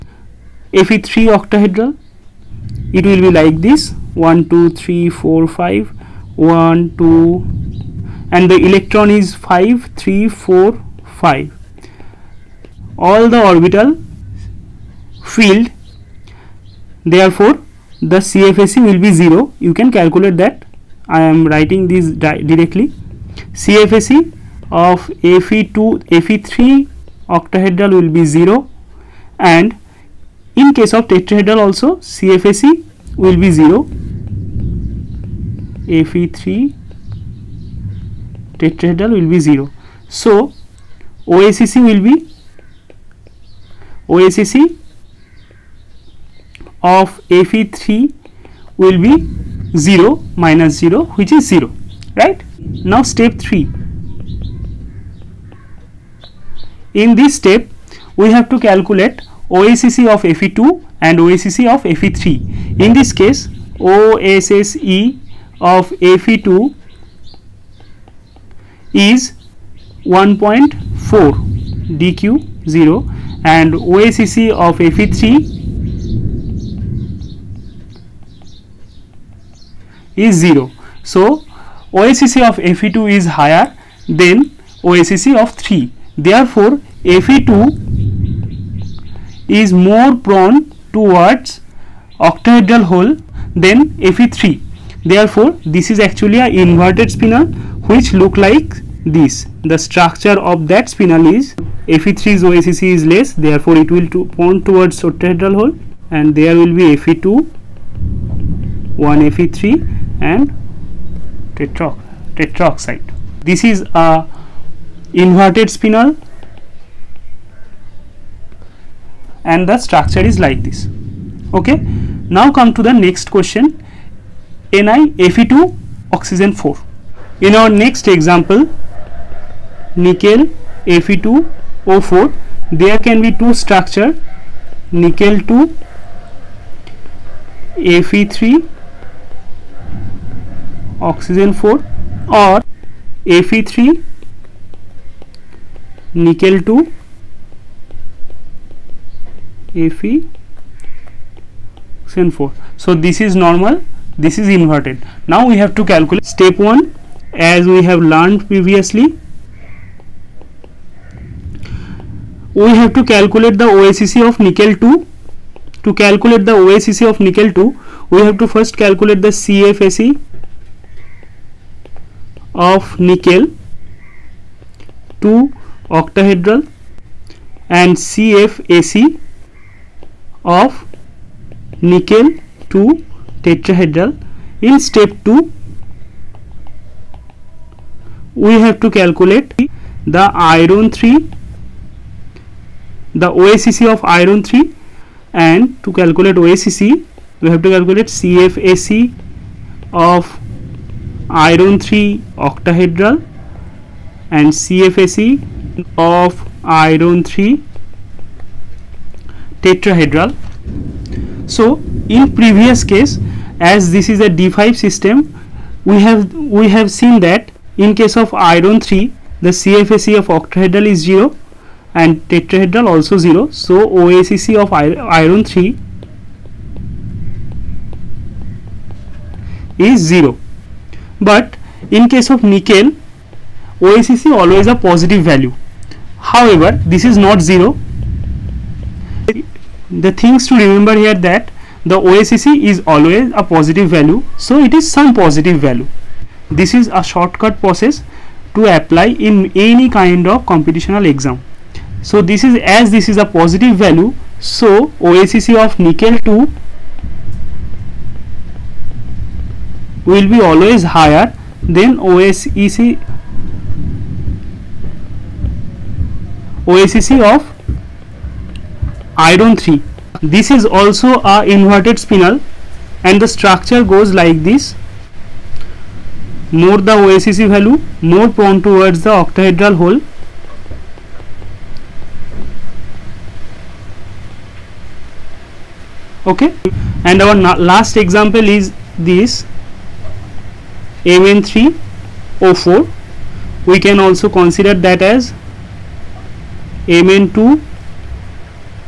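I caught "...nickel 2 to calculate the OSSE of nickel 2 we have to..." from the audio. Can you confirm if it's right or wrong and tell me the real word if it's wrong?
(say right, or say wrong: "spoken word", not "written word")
right.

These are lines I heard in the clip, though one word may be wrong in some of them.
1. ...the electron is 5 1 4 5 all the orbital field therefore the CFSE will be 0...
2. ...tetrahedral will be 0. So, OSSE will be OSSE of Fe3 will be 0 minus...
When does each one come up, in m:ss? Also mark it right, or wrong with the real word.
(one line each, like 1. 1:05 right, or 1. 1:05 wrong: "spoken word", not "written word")
1. 0:08 wrong: "3", not "1"
2. 0:38 right.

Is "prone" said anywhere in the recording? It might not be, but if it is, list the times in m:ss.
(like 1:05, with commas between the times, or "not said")
1:30, 4:38.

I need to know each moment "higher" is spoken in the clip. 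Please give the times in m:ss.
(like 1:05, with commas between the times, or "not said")
1:23, 4:20.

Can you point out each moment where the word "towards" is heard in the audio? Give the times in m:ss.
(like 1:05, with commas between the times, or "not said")
1:30, 1:44, 4:38.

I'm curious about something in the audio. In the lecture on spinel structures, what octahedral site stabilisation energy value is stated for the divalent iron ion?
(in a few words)
1.4 Dq0.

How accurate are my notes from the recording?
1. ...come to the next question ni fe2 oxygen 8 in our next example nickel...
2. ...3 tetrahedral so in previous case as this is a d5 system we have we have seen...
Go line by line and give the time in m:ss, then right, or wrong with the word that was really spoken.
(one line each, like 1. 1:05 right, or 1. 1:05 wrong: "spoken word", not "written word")
1. 2:02 wrong: "4", not "8"
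2. 3:27 right.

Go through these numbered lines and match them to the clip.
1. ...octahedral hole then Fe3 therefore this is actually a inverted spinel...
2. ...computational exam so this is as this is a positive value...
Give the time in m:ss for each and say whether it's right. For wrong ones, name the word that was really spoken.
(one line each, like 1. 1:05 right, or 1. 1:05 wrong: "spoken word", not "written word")
1. 1:32 right
2. 4:10 right.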